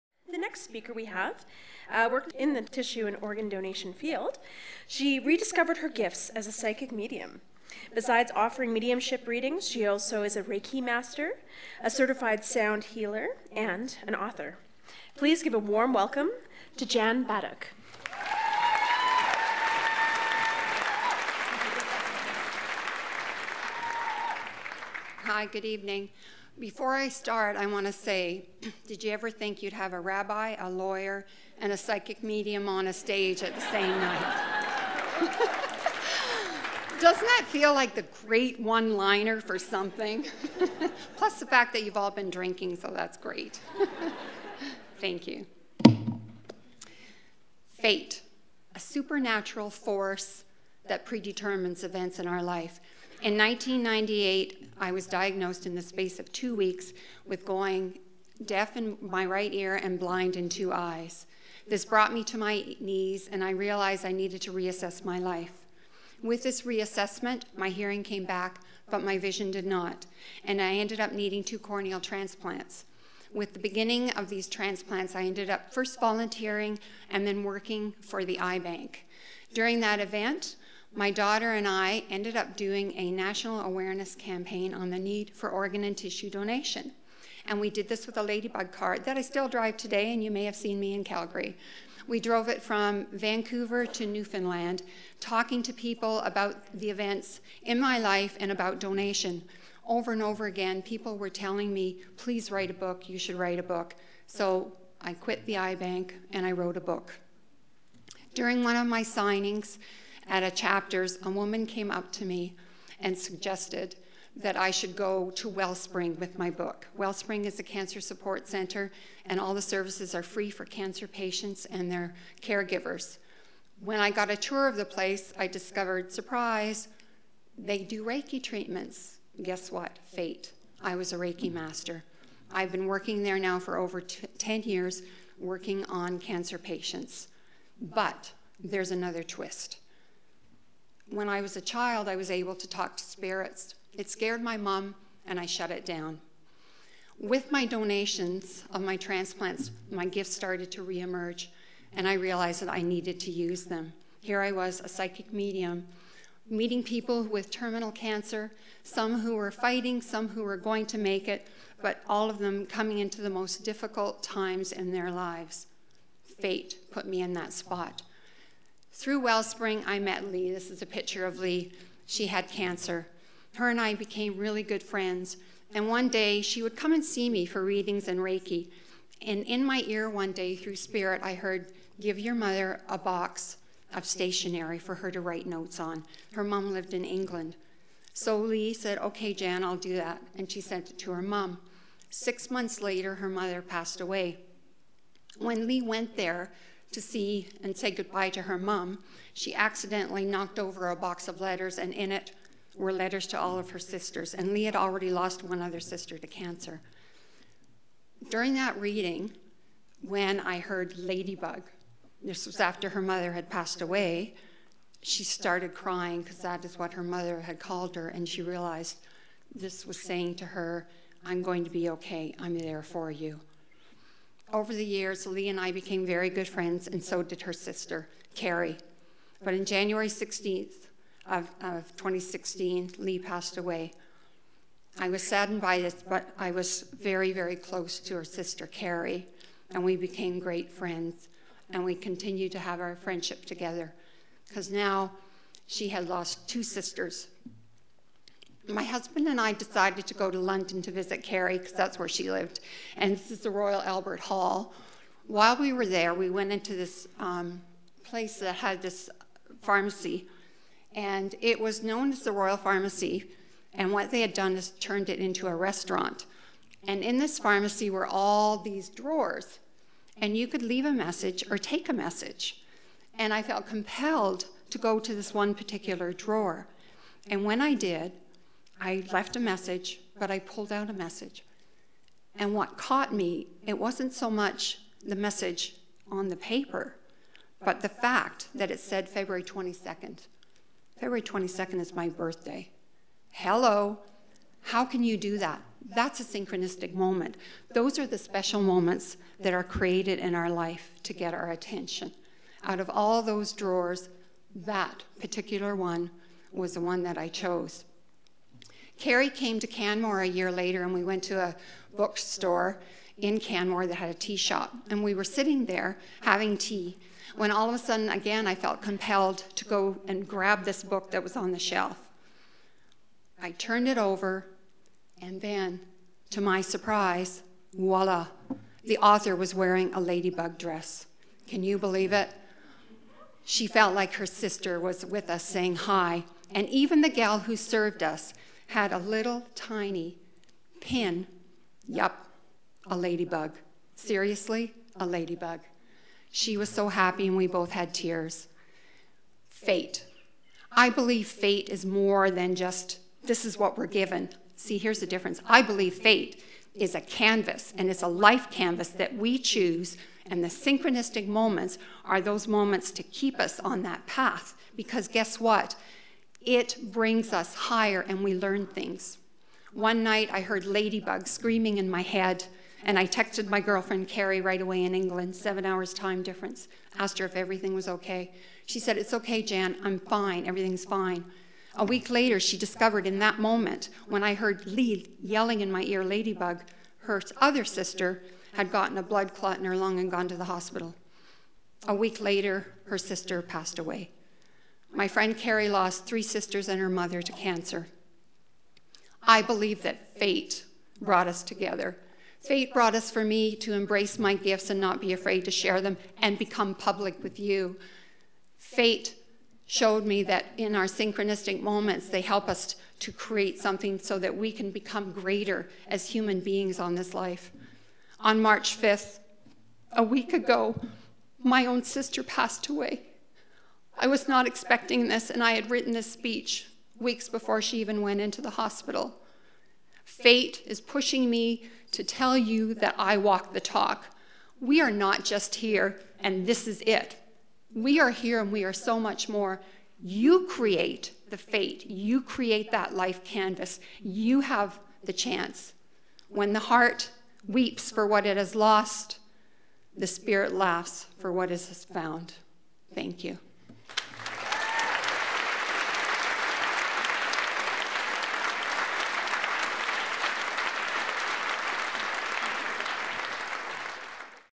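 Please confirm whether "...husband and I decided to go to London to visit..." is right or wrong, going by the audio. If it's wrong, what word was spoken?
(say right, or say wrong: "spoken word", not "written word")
right.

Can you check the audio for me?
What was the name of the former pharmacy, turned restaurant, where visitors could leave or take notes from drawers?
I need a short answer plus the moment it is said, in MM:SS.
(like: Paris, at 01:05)
Royal Pharmacy, at 04:22.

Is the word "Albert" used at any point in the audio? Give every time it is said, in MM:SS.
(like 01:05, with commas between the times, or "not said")
04:13.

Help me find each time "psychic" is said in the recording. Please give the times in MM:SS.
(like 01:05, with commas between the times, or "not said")
00:06, 00:31, 02:34.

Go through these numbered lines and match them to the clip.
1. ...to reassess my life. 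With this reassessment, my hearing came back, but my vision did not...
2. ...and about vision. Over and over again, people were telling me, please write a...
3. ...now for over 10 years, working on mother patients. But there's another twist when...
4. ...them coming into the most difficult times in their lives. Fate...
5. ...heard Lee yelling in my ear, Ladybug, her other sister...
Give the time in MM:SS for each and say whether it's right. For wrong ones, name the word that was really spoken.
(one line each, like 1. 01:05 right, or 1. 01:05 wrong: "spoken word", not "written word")
1. 01:04 right
2. 01:38 wrong: "donation", not "vision"
3. 02:13 wrong: "cancer", not "mother"
4. 02:42 right
5. 06:24 right.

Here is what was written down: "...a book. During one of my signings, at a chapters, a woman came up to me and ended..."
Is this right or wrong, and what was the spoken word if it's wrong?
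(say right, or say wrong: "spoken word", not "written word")
wrong: "suggested", not "ended".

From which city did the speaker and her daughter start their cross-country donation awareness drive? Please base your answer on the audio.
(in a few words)
Vancouver.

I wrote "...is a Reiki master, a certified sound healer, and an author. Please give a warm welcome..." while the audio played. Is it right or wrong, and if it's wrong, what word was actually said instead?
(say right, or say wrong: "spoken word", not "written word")
right.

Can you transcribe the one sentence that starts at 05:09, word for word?
Carrie came to Canmore a year later, and we went to a bookstore in Canmore that had a tea shop.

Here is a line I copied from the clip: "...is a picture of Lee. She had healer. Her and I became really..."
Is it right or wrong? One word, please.
wrong.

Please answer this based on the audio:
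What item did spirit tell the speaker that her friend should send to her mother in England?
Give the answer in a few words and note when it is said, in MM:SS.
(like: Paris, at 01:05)
A box of stationery, at 03:02.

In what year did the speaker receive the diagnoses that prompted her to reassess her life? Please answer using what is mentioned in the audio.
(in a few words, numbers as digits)
1998.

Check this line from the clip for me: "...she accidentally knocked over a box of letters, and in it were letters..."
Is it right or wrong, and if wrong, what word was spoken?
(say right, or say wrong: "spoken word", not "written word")
right.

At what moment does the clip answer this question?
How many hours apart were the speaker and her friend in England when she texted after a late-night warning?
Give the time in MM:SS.
06:15.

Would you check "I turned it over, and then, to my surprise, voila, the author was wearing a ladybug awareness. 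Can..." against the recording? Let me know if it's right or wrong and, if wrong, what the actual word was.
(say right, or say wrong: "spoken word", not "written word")
wrong: "dress", not "awareness".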